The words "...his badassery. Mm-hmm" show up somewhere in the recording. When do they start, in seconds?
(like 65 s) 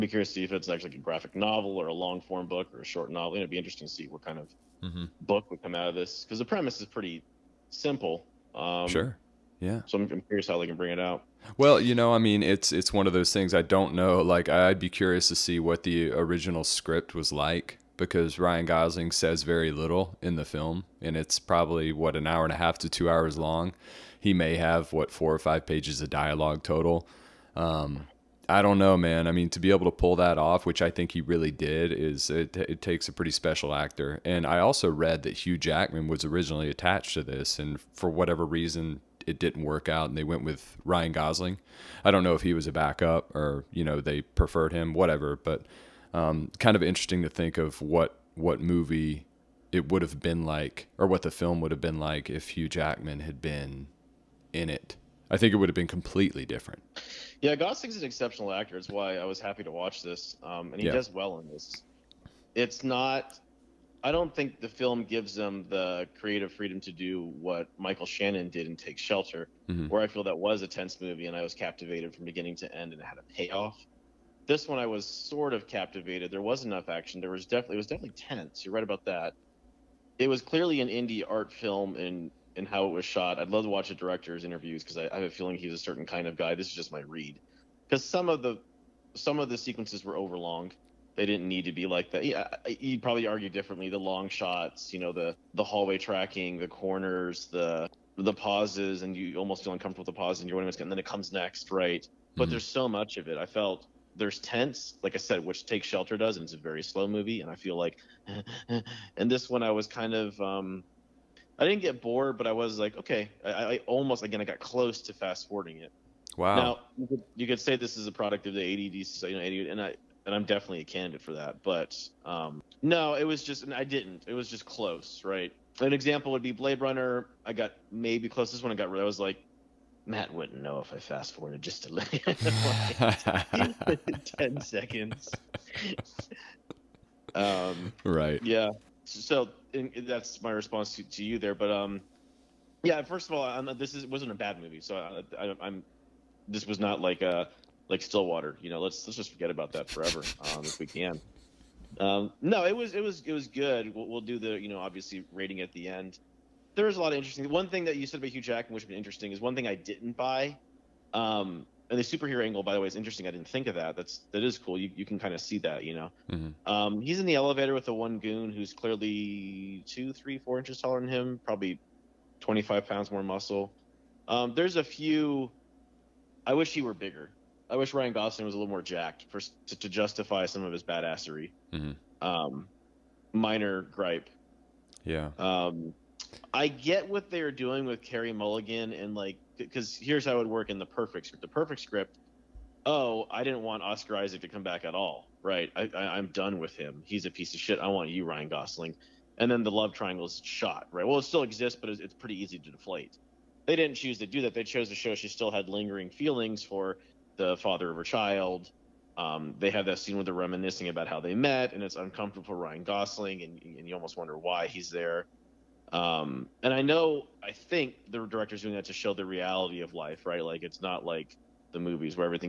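180 s.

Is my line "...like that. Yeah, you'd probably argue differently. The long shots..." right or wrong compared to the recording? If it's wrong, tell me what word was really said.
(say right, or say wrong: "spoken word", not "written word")
right.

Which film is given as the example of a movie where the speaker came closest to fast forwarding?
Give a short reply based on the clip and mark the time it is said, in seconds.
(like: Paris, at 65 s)
Blade Runner, at 126 s.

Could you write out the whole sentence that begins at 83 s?
I'd love to watch a director's interviews because I, I have a feeling he's a certain kind of guy.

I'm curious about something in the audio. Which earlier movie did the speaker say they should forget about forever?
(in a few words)
Stillwater.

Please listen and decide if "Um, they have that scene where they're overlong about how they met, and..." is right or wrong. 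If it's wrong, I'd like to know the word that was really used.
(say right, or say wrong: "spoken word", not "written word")
wrong: "reminiscing", not "overlong".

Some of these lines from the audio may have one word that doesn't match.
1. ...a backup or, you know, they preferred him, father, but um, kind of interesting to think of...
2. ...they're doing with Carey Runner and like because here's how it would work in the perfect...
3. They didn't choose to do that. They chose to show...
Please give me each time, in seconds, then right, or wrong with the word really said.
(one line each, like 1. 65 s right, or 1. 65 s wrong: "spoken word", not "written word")
1. 42 s wrong: "whatever", not "father"
2. 187 s wrong: "Mulligan", not "Runner"
3. 203 s right.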